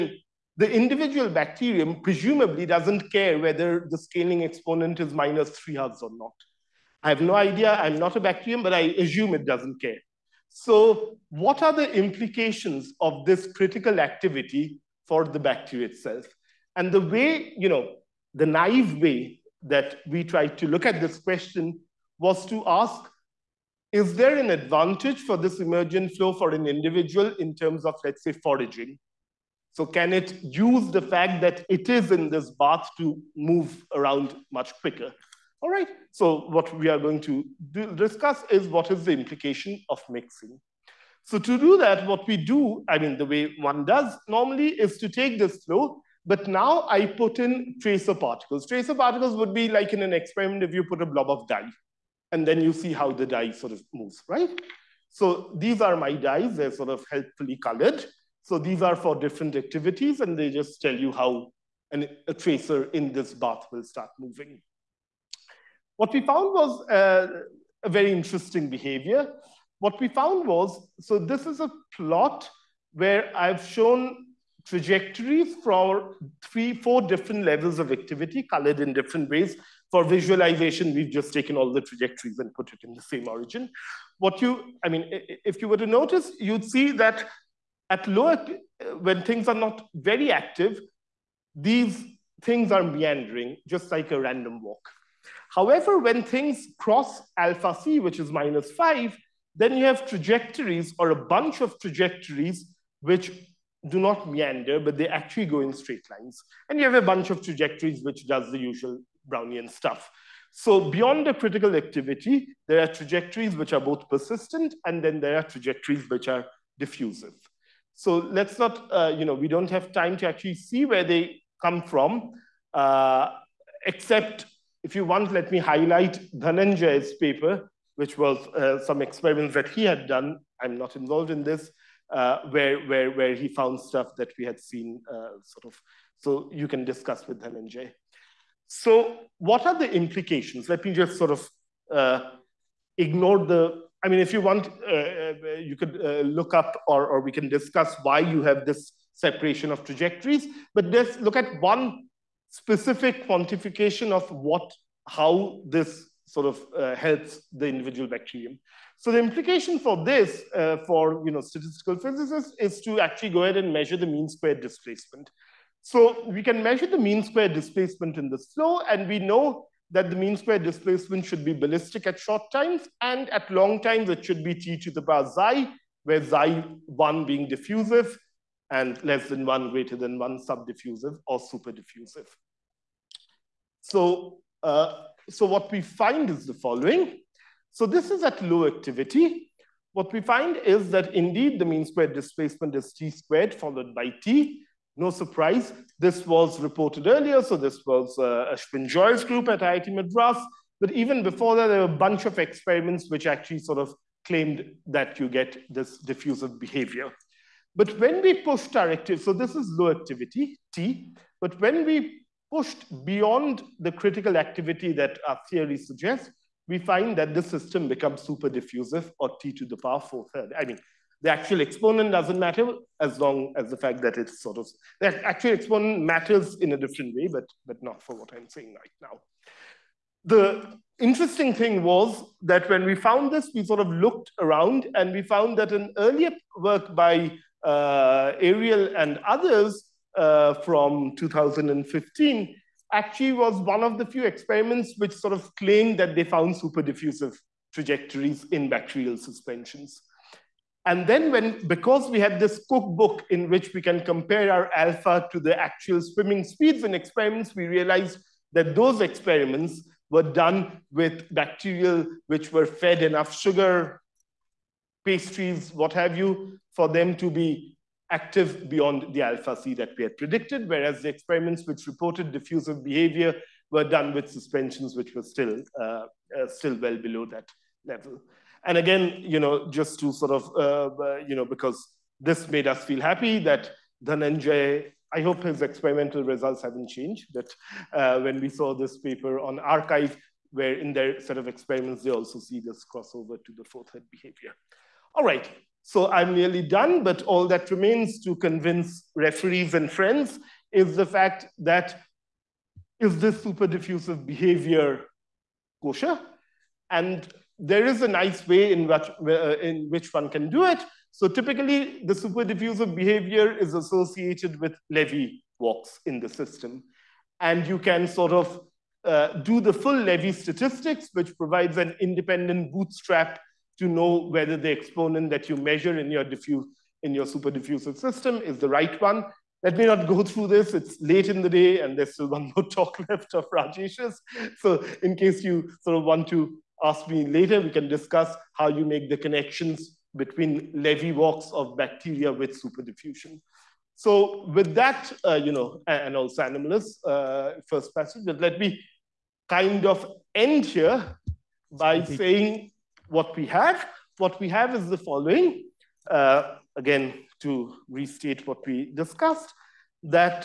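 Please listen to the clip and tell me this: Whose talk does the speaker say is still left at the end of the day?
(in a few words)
Rajesh's.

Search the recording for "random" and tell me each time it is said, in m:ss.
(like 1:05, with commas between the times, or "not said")
1:34.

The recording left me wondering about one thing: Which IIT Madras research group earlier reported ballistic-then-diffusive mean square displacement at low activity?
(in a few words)
Ashwin Joy's group.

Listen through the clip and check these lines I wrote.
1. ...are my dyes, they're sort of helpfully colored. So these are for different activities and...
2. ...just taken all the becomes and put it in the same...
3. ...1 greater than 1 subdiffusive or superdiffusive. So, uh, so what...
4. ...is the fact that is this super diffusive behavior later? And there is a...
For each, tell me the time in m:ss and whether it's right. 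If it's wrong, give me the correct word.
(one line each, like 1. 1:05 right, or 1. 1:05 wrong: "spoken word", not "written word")
1. 0:55 right
2. 1:21 wrong: "trajectories", not "becomes"
3. 2:59 right
4. 5:00 wrong: "kosher", not "later".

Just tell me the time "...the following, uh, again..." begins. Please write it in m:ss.
5:54.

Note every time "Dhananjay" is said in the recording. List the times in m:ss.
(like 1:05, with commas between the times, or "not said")
2:06, 2:17, 4:44.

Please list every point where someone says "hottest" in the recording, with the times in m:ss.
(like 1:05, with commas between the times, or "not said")
not said.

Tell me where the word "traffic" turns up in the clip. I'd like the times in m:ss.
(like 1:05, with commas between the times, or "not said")
not said.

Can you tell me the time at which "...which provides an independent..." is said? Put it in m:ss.
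5:21.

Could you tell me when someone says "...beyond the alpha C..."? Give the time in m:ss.
4:28.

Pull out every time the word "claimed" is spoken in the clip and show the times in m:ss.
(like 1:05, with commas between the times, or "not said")
3:24, 4:05.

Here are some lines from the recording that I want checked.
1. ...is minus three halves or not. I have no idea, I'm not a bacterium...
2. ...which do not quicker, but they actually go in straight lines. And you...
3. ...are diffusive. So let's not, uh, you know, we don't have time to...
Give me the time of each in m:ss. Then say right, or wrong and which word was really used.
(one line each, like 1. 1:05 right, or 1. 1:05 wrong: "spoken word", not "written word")
1. 0:05 right
2. 1:43 wrong: "meander", not "quicker"
3. 1:56 right.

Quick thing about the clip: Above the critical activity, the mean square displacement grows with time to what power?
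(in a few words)
4/3.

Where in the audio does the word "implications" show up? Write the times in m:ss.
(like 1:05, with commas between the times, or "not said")
0:11, 0:39, 2:19, 2:39.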